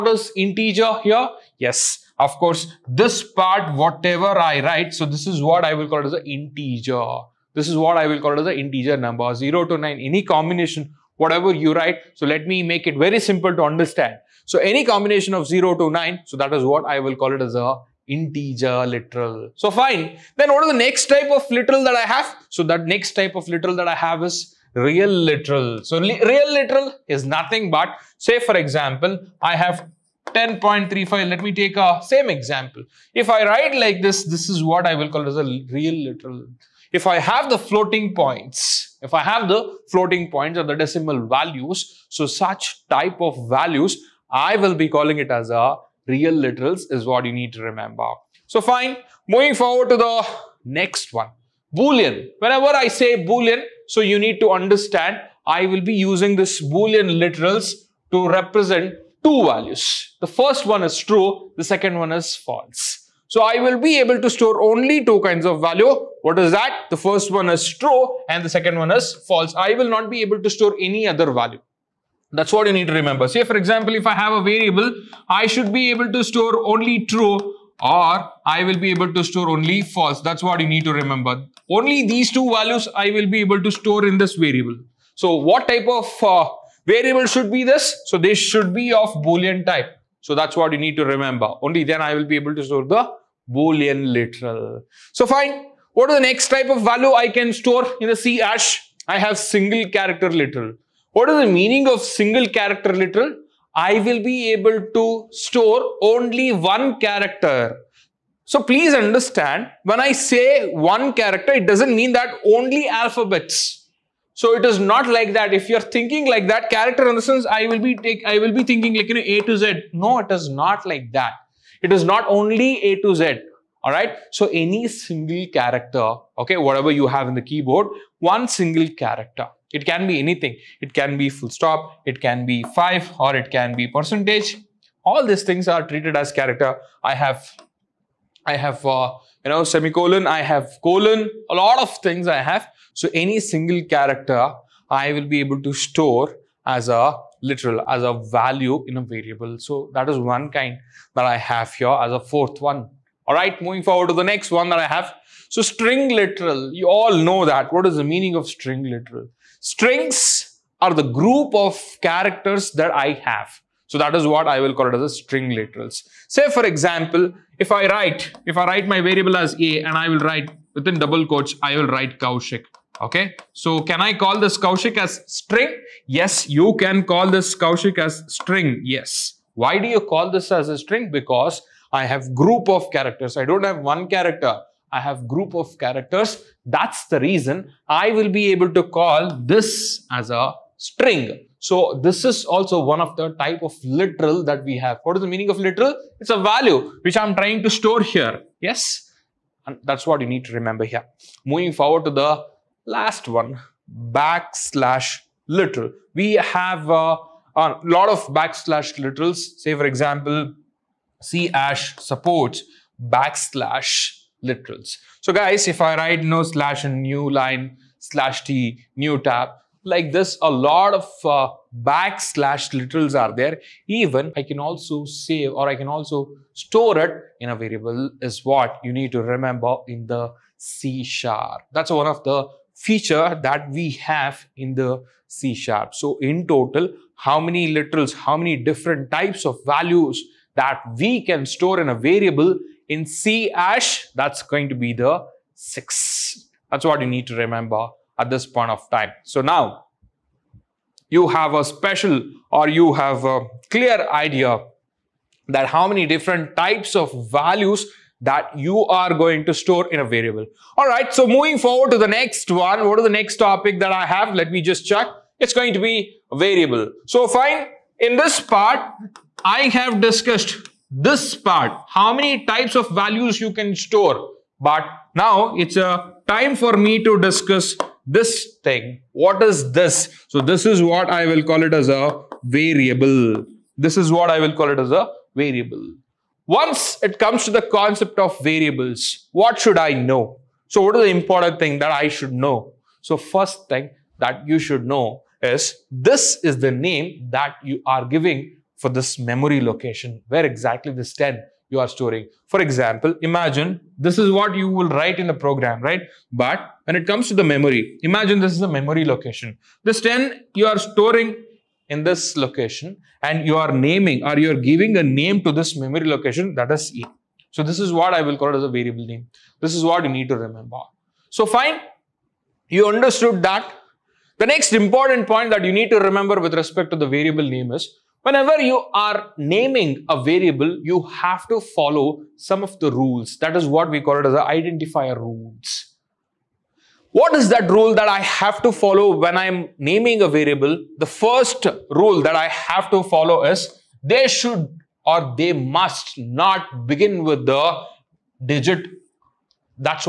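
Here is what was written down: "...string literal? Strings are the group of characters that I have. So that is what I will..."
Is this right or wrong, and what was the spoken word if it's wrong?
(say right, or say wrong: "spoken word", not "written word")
right.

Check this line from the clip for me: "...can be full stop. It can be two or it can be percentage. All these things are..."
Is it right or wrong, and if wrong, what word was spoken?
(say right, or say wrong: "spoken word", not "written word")
wrong: "five", not "two".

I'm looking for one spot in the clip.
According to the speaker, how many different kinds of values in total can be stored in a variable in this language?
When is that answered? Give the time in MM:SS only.
04:05.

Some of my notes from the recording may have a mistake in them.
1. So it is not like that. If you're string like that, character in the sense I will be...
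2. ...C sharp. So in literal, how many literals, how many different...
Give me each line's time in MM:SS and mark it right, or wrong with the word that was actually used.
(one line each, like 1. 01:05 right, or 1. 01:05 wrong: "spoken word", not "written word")
1. 01:54 wrong: "thinking", not "string"
2. 03:55 wrong: "total", not "literal".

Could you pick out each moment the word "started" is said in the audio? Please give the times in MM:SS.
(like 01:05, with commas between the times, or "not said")
not said.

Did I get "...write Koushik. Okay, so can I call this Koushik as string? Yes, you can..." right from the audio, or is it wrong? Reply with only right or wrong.
right.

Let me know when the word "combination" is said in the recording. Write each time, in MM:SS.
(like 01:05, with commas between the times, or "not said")
00:10, 00:14.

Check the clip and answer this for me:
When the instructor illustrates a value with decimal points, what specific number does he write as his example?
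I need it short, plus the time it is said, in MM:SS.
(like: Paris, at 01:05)
10.35, at 00:30.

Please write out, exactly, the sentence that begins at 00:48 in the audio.
So fine, moving forward to the next one, Boolean.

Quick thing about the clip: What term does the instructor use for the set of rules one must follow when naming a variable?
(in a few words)
identifier rules.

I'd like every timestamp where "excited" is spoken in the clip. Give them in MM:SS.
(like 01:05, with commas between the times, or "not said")
not said.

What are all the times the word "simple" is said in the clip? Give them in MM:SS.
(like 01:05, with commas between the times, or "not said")
00:13.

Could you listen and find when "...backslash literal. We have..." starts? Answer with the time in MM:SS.
03:24.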